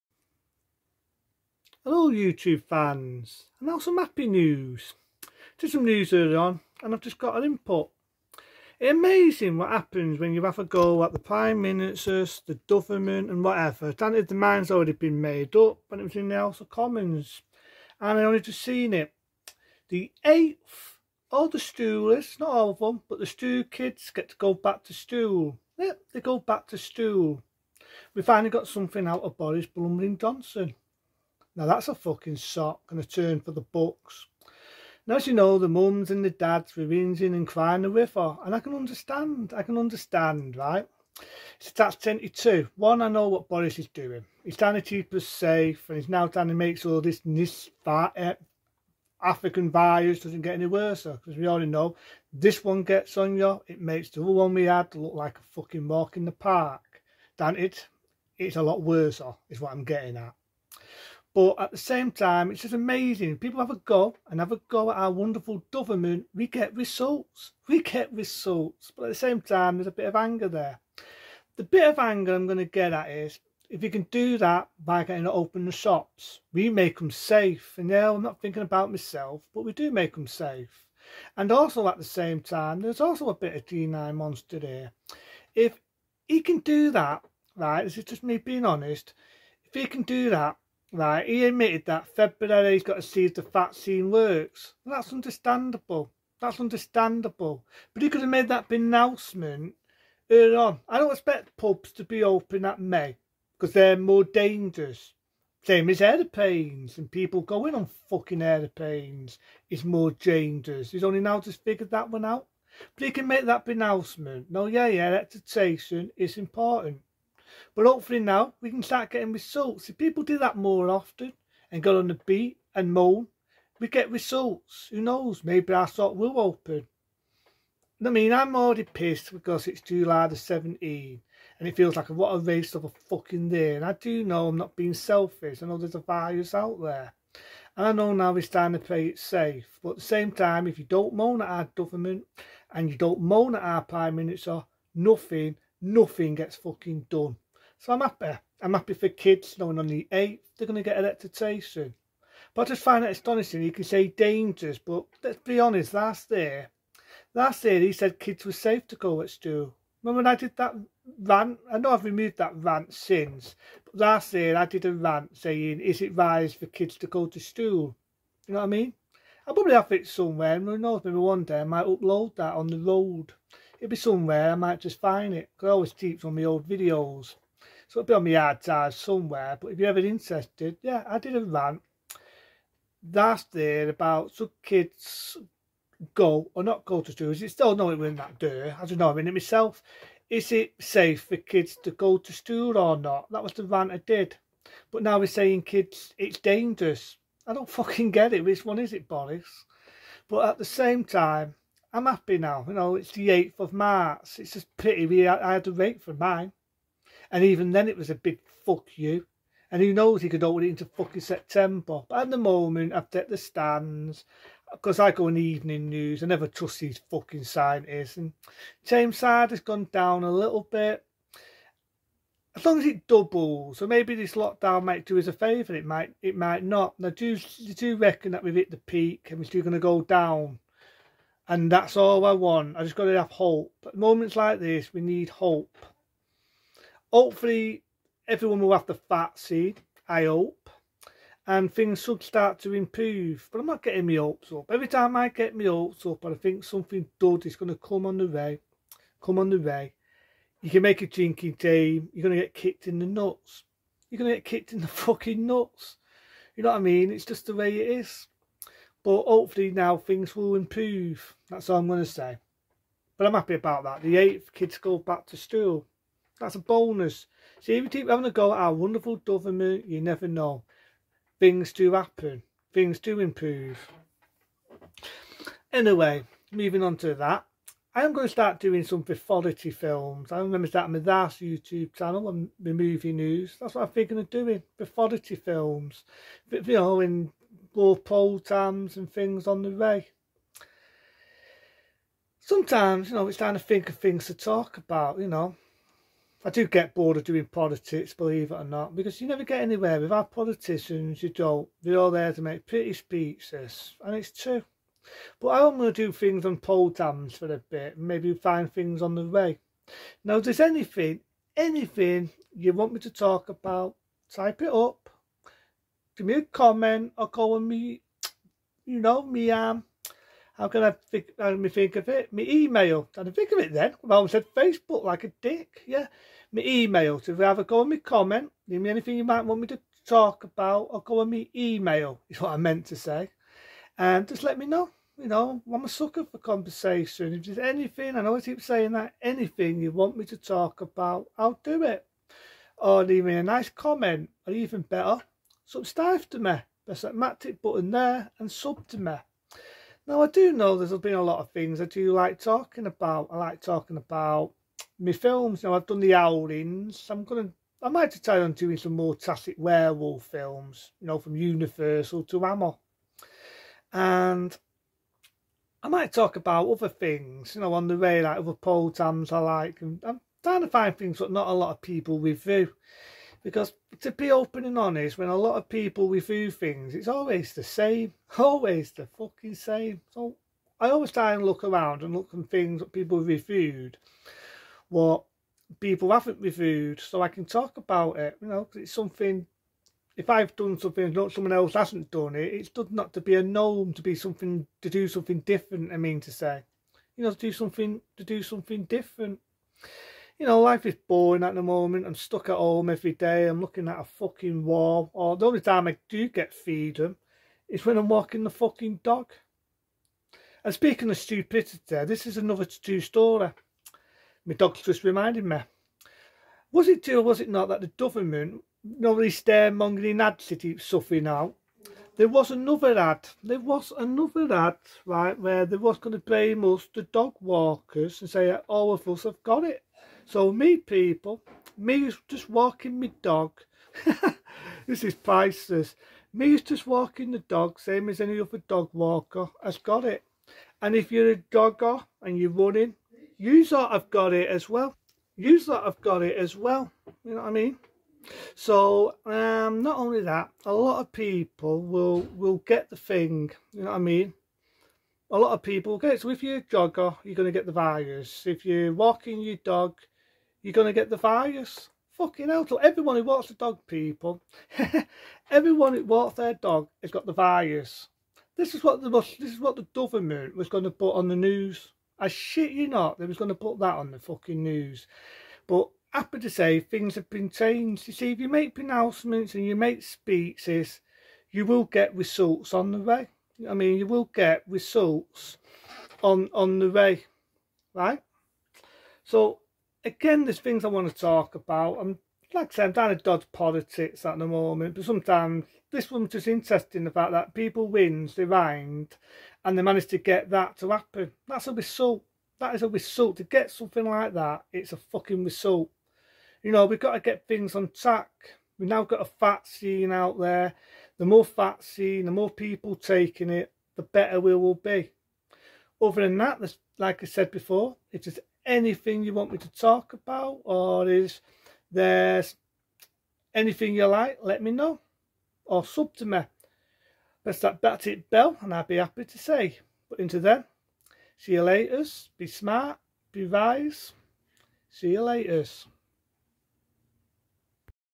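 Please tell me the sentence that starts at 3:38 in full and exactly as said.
And James side has gone down a little bit.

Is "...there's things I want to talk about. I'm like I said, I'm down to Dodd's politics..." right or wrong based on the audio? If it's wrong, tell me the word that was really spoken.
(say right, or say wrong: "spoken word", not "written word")
right.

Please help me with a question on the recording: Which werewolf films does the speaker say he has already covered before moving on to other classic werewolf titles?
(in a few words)
The Howlings.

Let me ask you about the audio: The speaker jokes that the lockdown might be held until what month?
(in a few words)
September.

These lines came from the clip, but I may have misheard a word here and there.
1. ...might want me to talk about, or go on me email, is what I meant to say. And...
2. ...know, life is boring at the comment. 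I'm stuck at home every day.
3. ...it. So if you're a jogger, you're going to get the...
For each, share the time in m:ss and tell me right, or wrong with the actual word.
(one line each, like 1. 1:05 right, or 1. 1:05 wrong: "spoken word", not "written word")
1. 5:29 right
2. 6:40 wrong: "moment", not "comment"
3. 7:36 right.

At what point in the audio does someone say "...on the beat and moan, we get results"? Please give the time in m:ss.
2:01.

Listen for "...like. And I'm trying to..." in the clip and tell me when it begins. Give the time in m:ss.
6:09.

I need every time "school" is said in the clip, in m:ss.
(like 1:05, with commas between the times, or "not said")
2:39, 2:47, 3:07, 3:12, 4:25.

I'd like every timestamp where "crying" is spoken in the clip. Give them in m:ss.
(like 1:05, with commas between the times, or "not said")
0:37.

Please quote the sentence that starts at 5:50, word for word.
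Now I do know there's been a lot of things I do like talking about.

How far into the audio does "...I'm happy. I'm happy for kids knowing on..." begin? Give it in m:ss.
2:27.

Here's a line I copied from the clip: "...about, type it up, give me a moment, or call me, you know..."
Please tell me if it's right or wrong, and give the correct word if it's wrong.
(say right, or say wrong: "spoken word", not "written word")
wrong: "comment", not "moment".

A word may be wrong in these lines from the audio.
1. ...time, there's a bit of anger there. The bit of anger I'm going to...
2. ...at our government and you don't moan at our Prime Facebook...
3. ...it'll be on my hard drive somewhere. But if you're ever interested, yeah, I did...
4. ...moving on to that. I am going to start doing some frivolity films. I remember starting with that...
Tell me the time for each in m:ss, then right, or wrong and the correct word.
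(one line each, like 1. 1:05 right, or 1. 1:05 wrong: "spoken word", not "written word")
1. 1:09 right
2. 2:21 wrong: "Minister", not "Facebook"
3. 2:57 right
4. 4:36 right.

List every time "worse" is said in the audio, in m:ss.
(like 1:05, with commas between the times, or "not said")
0:50, 0:58.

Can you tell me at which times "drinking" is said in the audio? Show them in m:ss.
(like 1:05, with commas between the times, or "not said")
4:11.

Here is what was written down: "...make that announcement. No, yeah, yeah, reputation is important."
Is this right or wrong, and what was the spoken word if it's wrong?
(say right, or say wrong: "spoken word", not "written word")
right.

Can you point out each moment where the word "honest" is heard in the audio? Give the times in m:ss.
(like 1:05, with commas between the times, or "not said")
1:28, 2:35, 6:14.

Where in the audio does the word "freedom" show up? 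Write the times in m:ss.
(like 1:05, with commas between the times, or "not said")
6:46.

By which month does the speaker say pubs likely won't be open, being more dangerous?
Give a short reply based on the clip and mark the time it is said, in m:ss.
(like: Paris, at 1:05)
May, at 1:42.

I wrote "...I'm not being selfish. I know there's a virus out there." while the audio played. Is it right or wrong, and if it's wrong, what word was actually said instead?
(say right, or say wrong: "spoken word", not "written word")
right.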